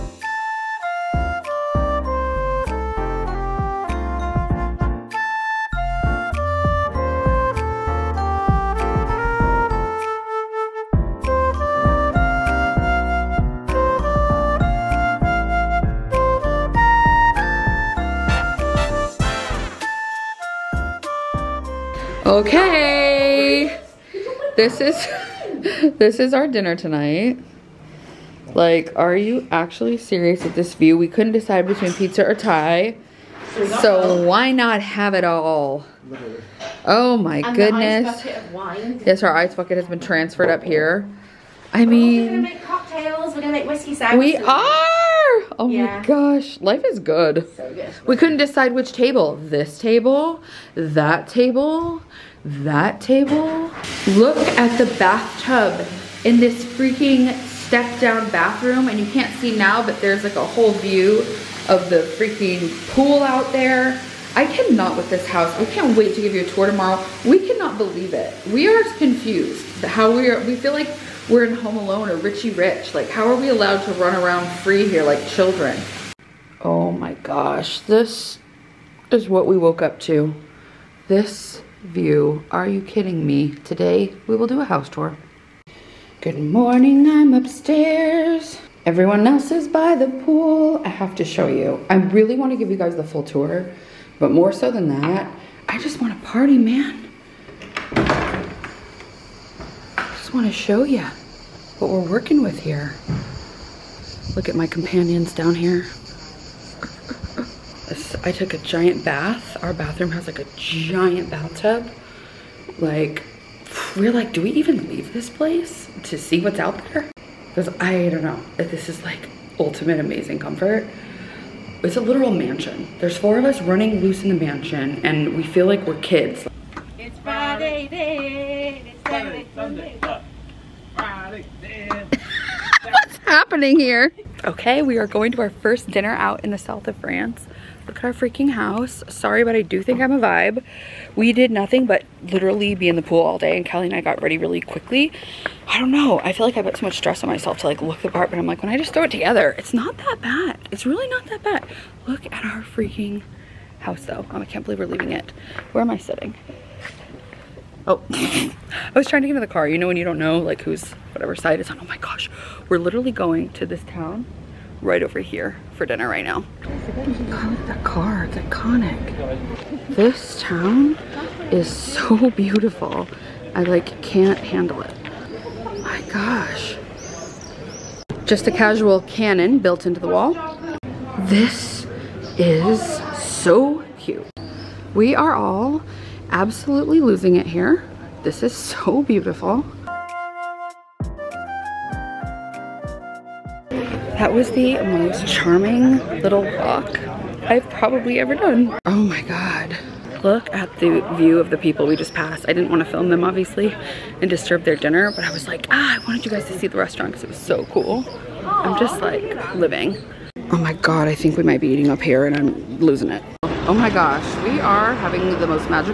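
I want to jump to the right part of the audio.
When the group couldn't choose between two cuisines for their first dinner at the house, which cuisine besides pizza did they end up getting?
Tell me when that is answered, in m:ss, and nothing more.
0:32.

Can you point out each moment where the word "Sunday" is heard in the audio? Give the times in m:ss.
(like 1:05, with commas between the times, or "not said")
2:09.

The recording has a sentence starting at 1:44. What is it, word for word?
Look at my companions down here.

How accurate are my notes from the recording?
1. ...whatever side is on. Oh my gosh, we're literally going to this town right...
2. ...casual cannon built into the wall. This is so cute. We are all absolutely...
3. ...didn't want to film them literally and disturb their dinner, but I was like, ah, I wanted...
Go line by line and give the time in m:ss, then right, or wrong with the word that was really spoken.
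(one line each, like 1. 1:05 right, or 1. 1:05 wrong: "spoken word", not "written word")
1. 2:41 right
2. 2:58 right
3. 3:22 wrong: "obviously", not "literally".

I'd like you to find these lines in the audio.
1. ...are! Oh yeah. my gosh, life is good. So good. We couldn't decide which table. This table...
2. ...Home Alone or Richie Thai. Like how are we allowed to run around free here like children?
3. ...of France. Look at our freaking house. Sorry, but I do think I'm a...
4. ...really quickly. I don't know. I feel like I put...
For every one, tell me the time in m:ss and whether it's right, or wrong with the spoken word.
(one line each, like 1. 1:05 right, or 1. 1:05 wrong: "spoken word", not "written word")
1. 0:44 right
2. 1:11 wrong: "Rich", not "Thai"
3. 2:16 right
4. 2:24 right.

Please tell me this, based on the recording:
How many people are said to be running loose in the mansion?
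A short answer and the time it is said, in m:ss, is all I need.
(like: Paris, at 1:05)
4, at 2:03.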